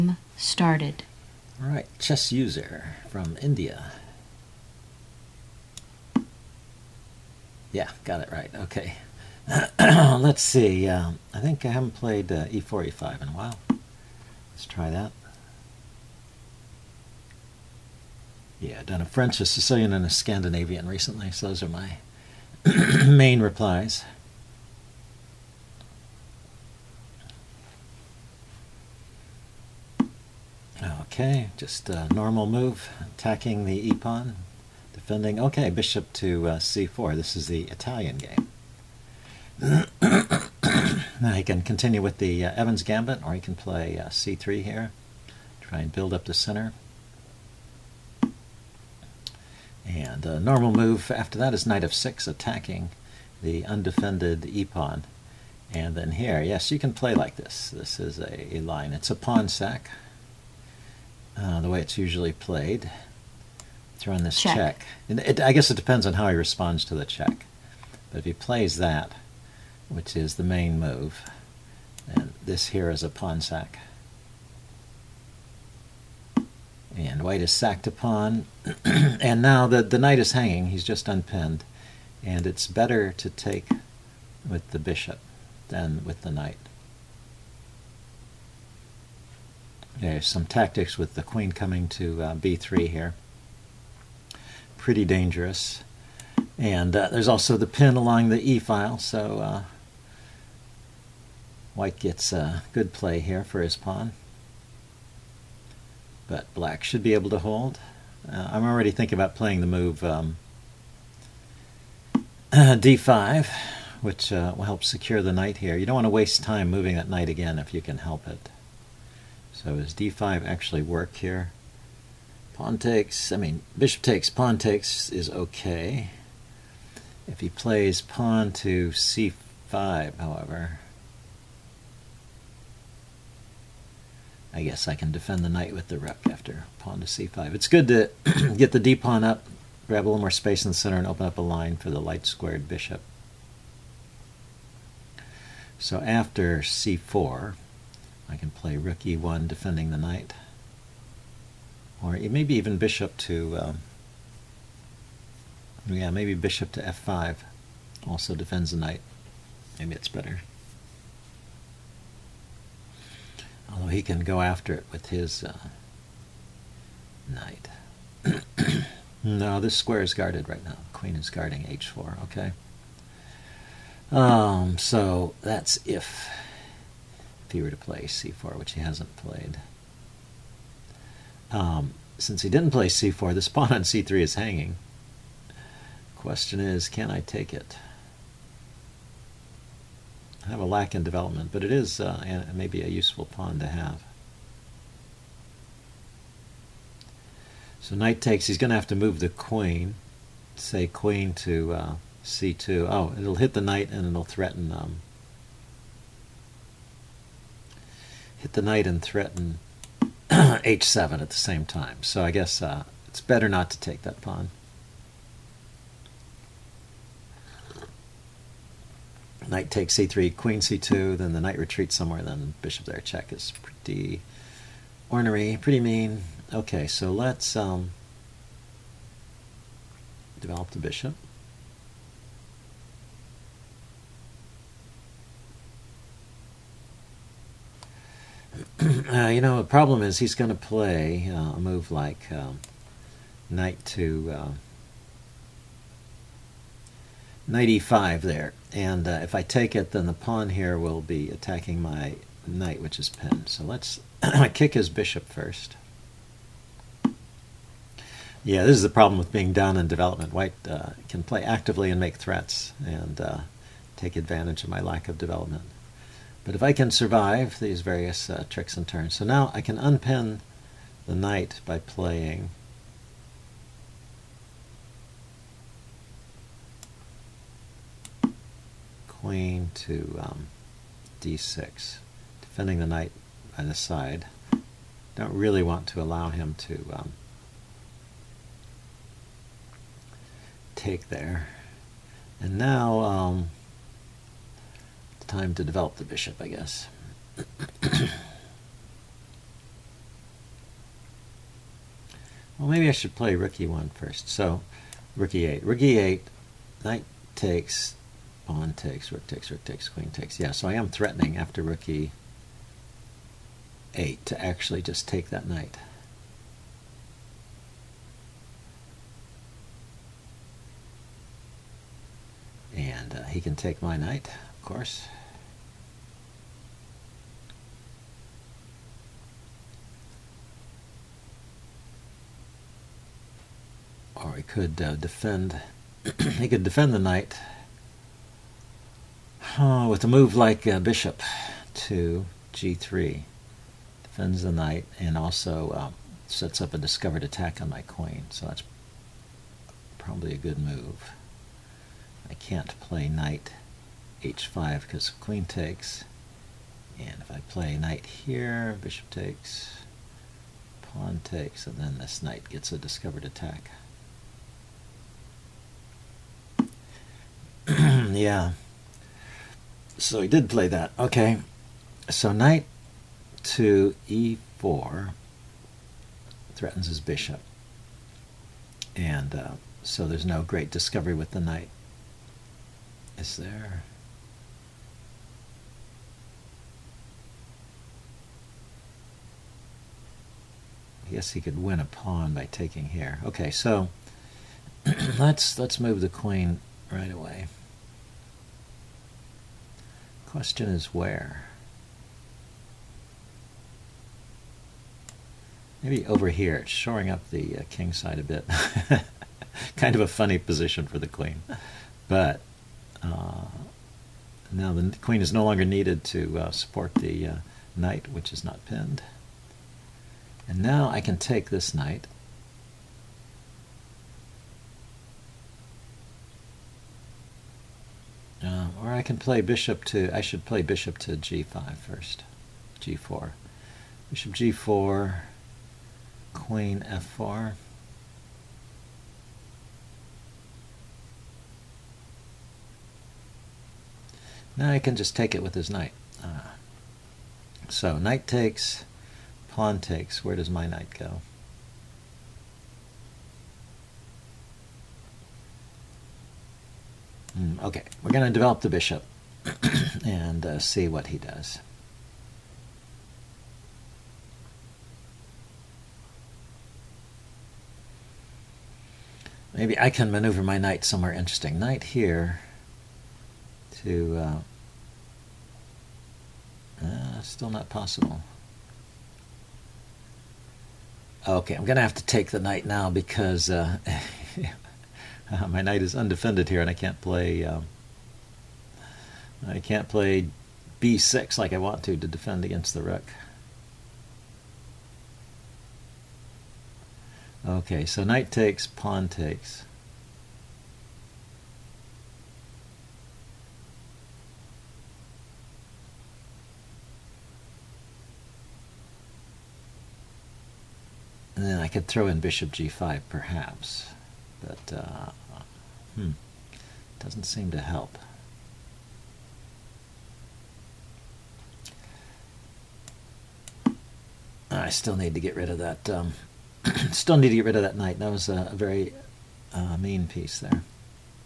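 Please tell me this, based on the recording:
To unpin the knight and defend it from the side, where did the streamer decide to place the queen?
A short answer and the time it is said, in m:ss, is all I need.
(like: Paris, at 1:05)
d6, at 4:41.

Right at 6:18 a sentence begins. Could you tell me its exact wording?
And uh, so there's no great discovery with the knight.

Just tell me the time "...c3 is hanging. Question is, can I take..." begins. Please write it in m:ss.
3:03.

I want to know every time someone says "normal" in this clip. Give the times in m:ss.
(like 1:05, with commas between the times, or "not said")
0:32, 0:50.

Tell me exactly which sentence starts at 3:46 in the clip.
Okay, so let's um, develop the bishop.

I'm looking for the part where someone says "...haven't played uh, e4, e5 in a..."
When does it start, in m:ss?
0:11.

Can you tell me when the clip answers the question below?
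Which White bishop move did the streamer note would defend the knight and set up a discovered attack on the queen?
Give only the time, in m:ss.
5:40.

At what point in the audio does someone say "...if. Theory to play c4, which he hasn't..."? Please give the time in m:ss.
2:55.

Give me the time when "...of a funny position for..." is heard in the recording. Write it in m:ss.
6:49.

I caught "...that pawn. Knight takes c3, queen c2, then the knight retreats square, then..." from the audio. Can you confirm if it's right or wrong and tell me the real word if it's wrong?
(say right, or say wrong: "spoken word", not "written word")
wrong: "somewhere", not "square".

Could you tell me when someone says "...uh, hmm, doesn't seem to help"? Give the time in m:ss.
8:34.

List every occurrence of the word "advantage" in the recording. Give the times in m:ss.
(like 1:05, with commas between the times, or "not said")
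4:24.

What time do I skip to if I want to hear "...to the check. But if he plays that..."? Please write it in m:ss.
1:06.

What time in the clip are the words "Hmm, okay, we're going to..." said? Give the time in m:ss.
7:37.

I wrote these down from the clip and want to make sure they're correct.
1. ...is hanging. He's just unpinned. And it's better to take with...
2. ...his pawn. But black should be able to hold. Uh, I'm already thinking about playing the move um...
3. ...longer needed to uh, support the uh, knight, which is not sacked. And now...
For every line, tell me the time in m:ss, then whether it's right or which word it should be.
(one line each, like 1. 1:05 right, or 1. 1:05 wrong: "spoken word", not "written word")
1. 1:20 right
2. 1:43 right
3. 6:55 wrong: "pinned", not "sacked".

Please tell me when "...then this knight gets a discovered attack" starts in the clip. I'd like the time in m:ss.
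6:01.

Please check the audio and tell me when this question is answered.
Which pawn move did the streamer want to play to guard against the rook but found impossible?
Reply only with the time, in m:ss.
8:10.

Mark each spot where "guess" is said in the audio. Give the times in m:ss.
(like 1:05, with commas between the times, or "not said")
1:05, 2:14, 3:32, 4:56.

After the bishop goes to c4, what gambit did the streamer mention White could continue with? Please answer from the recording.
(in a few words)
Evans gambit.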